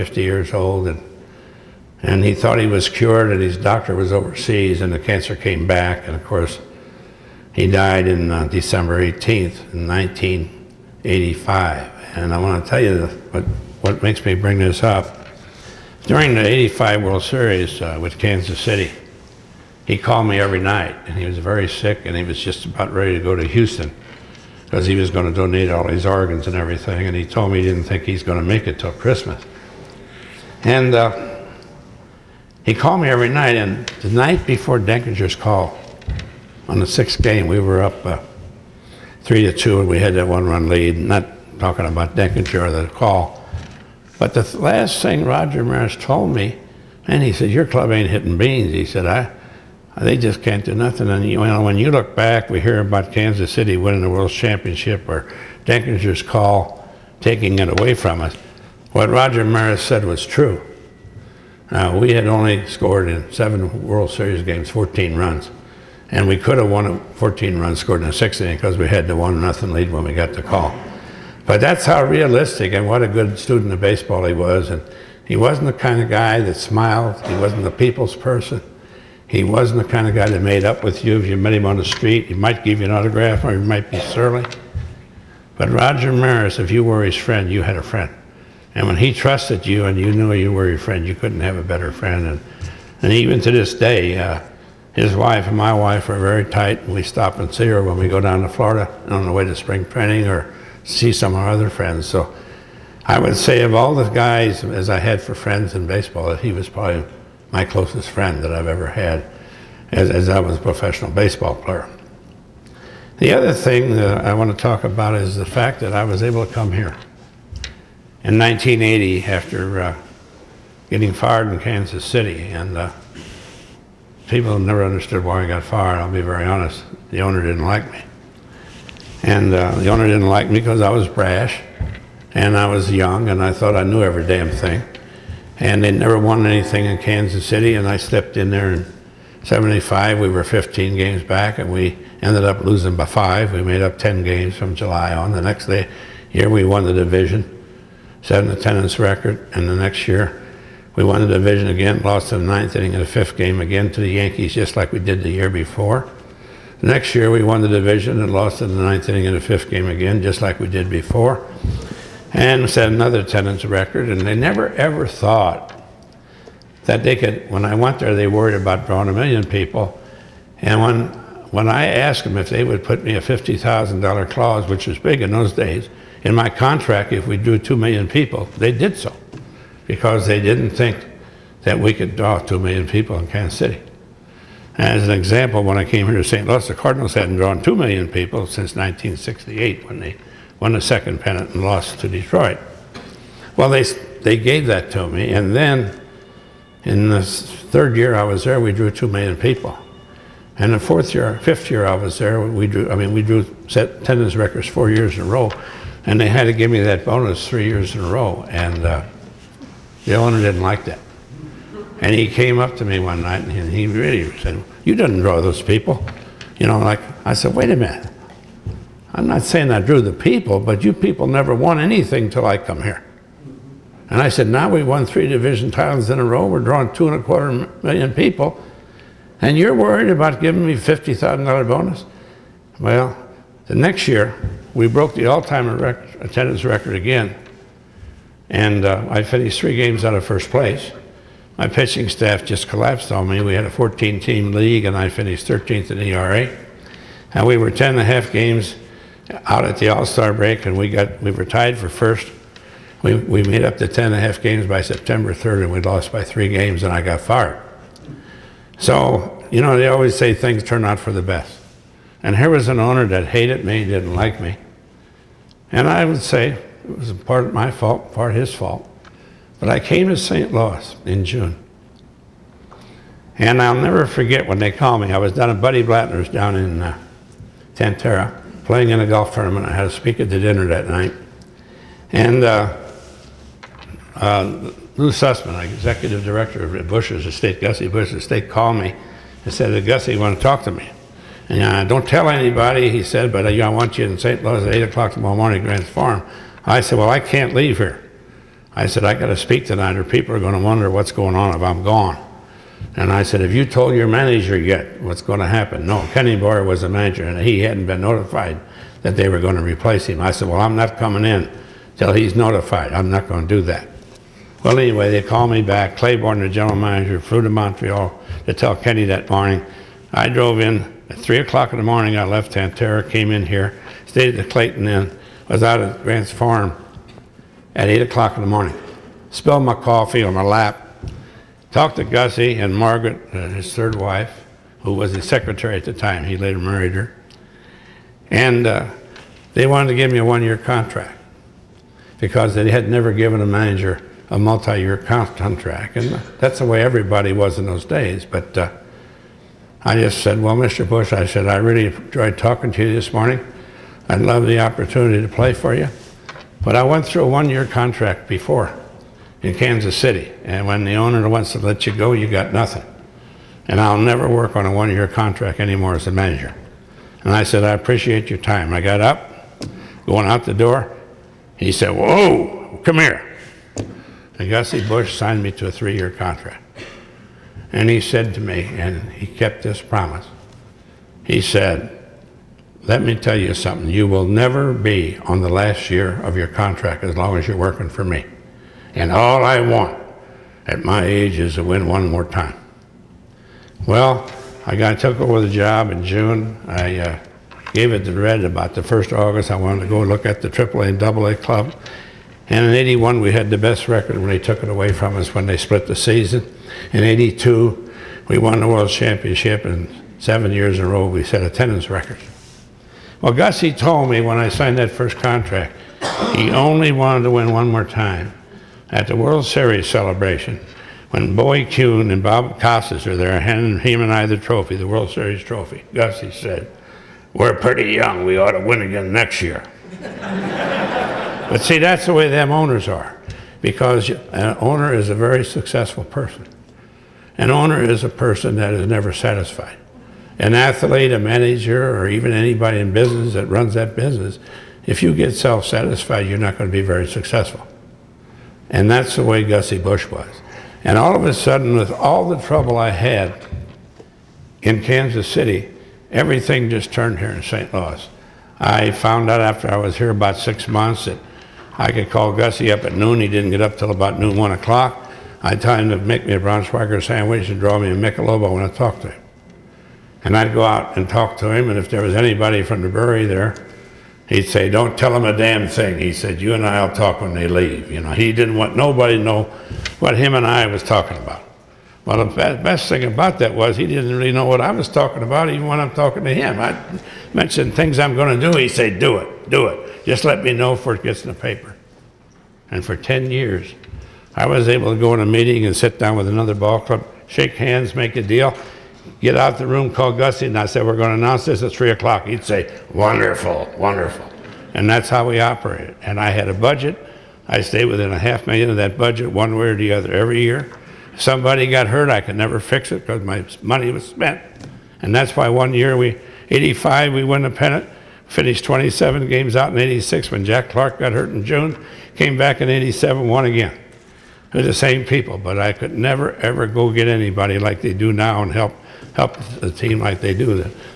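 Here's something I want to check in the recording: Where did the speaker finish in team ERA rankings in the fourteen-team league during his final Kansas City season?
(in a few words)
13th.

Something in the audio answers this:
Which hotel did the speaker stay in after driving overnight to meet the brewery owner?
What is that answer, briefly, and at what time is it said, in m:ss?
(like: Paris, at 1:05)
Clayton Inn, at 5:24.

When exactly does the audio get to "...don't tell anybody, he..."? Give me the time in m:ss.
4:51.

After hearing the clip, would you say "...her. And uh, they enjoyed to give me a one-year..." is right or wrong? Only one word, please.
wrong.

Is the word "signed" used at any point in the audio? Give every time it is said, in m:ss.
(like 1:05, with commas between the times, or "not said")
6:15, 6:54.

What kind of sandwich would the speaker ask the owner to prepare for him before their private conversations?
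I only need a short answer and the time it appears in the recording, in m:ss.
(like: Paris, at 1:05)
Braunschweiger, at 7:46.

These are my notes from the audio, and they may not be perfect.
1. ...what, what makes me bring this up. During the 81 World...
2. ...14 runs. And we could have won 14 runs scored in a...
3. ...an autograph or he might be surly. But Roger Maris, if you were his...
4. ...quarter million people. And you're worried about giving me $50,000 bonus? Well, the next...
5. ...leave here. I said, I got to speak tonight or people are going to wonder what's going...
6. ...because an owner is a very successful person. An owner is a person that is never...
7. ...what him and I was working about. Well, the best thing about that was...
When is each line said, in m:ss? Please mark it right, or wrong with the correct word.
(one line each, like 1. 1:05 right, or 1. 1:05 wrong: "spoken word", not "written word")
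1. 0:13 wrong: "85", not "81"
2. 1:04 right
3. 1:22 right
4. 3:47 right
5. 4:57 right
6. 7:13 right
7. 7:59 wrong: "talking", not "working".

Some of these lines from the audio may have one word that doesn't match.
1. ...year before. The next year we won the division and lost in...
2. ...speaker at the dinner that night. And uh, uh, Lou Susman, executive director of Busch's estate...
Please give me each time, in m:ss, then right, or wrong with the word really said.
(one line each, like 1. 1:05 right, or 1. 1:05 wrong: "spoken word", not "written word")
1. 2:35 right
2. 4:39 right.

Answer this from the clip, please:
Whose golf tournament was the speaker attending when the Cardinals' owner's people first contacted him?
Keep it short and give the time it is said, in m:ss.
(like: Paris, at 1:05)
Buddy Blattner, at 4:35.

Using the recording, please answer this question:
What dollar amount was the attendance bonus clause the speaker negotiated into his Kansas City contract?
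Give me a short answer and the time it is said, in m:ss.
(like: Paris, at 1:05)
$50,000, at 2:53.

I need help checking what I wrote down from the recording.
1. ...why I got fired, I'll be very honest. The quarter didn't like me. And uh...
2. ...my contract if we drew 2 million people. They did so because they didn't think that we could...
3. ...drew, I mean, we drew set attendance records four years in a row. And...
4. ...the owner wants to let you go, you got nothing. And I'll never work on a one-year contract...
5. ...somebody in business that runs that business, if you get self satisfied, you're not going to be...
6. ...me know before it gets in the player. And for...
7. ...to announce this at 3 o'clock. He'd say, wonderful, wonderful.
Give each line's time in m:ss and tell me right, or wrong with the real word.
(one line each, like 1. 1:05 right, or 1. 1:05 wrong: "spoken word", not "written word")
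1. 2:05 wrong: "owner", not "quarter"
2. 2:56 right
3. 3:22 right
4. 6:00 right
5. 7:22 wrong: "anybody", not "somebody"
6. 8:10 wrong: "paper", not "player"
7. 8:21 right.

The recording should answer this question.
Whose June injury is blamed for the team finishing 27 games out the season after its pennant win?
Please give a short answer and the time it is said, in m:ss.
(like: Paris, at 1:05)
Jack Clark, at 8:40.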